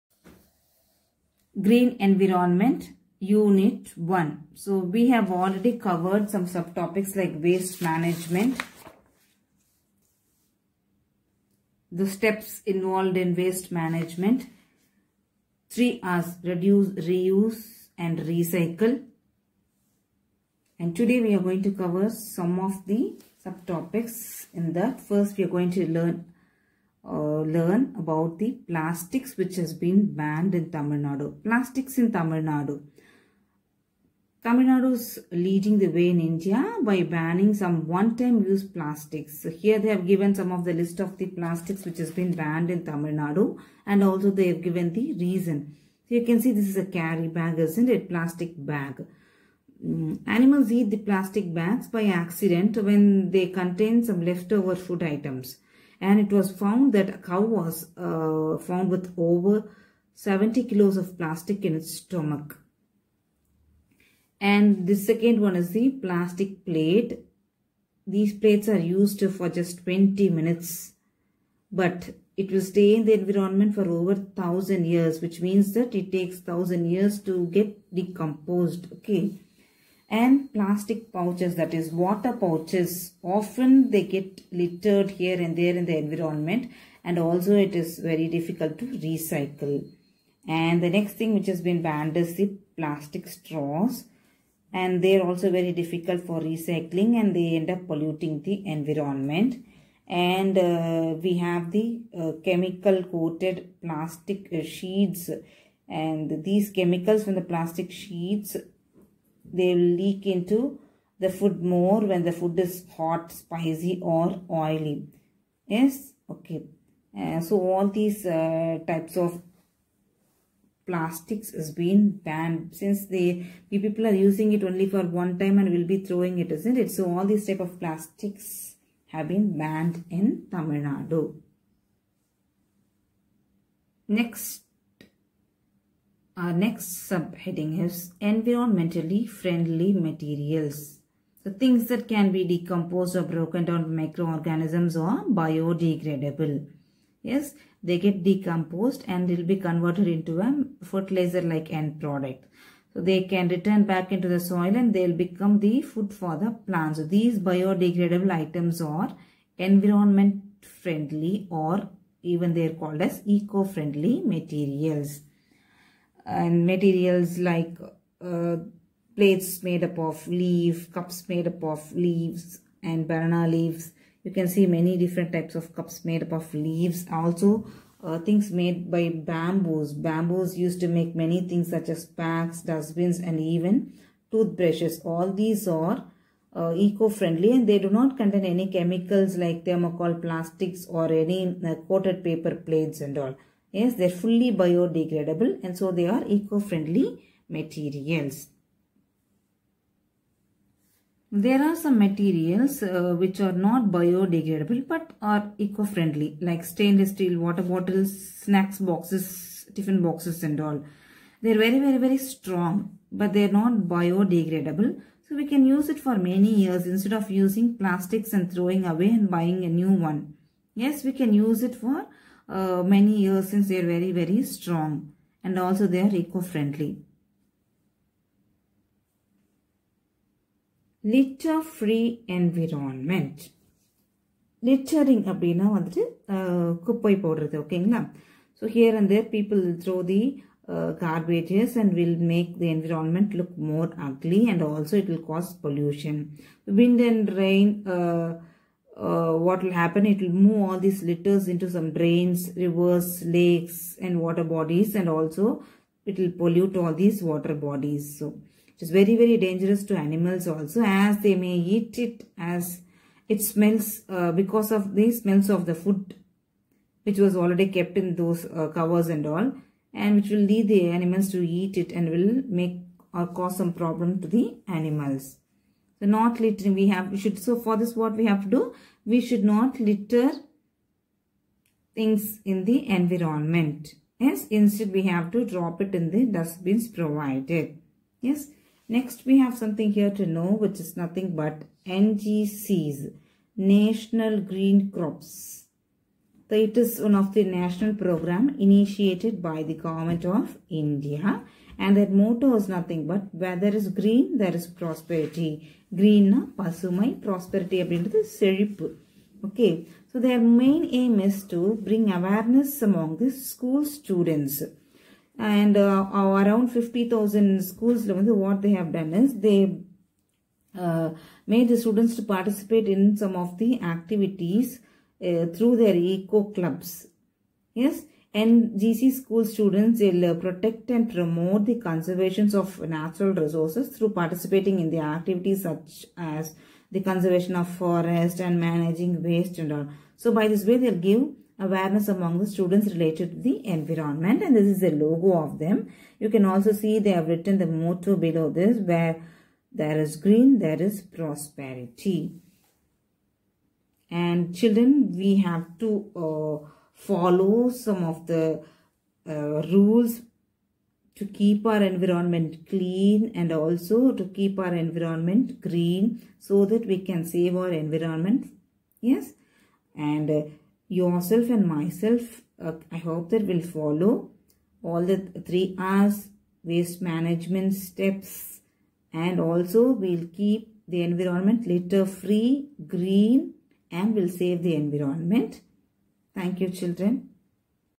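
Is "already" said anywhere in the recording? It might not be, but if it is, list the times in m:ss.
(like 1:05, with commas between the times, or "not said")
0:05, 4:27.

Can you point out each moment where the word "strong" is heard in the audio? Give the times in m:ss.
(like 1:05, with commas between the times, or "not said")
3:32, 3:44.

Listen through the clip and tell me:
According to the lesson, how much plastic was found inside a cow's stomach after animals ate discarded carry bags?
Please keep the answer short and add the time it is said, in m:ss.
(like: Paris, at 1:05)
over 70 kilos, at 0:59.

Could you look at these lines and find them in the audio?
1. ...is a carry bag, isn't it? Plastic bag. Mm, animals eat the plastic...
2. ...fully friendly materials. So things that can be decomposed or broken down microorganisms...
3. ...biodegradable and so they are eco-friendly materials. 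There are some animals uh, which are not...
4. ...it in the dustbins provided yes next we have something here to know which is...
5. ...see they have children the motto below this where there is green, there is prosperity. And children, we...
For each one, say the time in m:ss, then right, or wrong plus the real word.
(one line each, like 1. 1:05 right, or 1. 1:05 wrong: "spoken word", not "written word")
1. 0:46 right
2. 2:18 wrong: "environmentally", not "fully"
3. 3:14 wrong: "materials", not "animals"
4. 4:45 right
5. 5:46 wrong: "written", not "children".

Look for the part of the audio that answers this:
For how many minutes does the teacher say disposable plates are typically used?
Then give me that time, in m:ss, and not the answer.
1:09.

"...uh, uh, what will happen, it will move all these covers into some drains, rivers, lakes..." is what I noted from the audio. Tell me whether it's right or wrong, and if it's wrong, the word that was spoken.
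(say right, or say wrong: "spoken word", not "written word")
wrong: "litters", not "covers".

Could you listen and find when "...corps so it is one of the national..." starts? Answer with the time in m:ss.
4:54.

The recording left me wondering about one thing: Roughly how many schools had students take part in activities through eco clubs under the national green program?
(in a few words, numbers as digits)
50,000.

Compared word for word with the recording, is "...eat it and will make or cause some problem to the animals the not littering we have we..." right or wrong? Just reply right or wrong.
right.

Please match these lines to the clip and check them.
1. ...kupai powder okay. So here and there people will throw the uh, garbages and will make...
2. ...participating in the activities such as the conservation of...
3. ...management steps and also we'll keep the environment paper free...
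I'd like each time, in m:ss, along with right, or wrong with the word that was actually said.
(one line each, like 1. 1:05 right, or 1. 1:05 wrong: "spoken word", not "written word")
1. 3:56 right
2. 5:34 right
3. 6:17 wrong: "litter", not "paper".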